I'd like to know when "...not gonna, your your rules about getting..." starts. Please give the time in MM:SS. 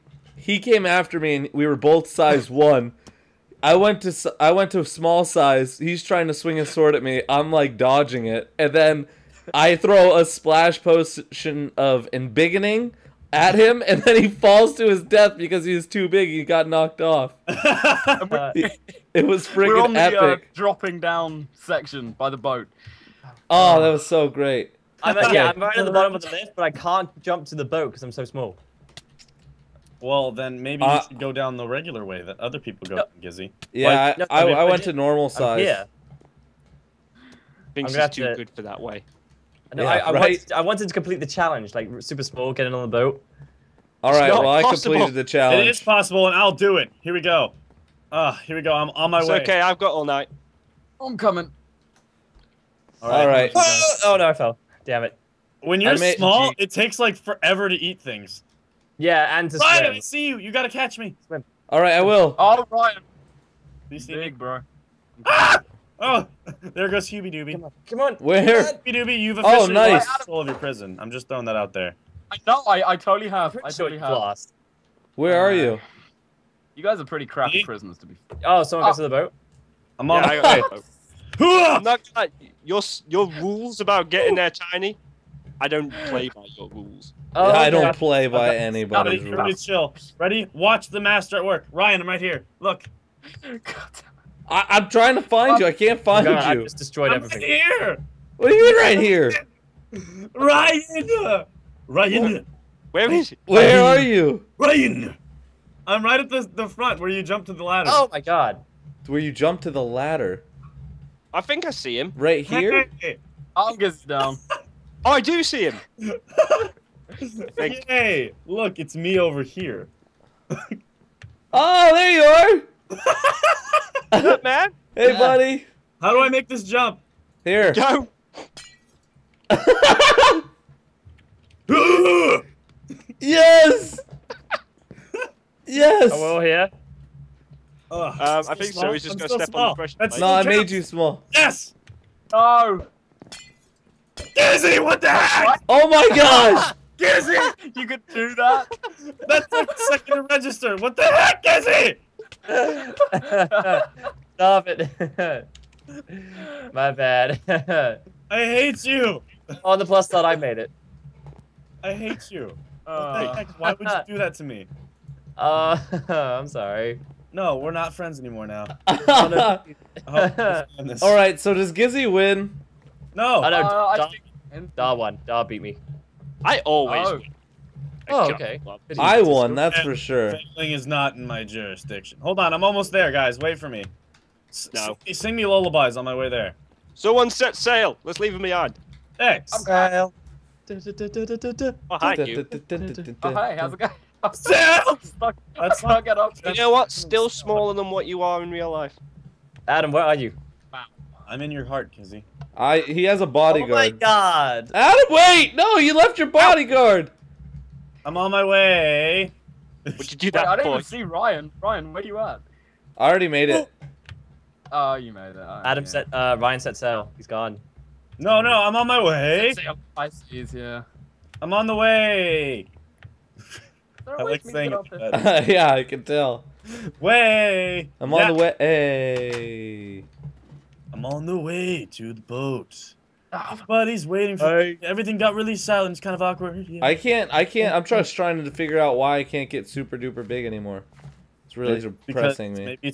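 01:21.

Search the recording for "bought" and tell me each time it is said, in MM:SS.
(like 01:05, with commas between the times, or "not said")
not said.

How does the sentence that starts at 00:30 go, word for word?
Well, then maybe uh, should go down the regular way that other people go, no.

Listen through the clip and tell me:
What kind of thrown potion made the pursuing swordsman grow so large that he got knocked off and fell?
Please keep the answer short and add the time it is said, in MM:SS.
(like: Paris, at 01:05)
Splash potion of embiggening, at 00:10.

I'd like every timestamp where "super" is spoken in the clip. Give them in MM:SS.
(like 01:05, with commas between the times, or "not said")
00:41, 03:59.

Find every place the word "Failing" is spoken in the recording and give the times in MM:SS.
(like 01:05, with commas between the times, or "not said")
03:00.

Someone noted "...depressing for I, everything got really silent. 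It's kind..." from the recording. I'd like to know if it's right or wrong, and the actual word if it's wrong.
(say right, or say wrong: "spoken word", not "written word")
wrong: "waiting", not "depressing".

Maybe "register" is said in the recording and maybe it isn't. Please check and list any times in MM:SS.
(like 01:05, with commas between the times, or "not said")
02:30.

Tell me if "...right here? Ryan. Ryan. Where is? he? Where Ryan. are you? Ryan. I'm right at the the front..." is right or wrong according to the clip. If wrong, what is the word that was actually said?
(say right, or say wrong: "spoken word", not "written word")
right.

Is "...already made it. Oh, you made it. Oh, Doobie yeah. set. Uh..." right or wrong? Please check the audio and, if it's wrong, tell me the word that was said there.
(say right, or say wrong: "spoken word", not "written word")
wrong: "Adam", not "Doobie".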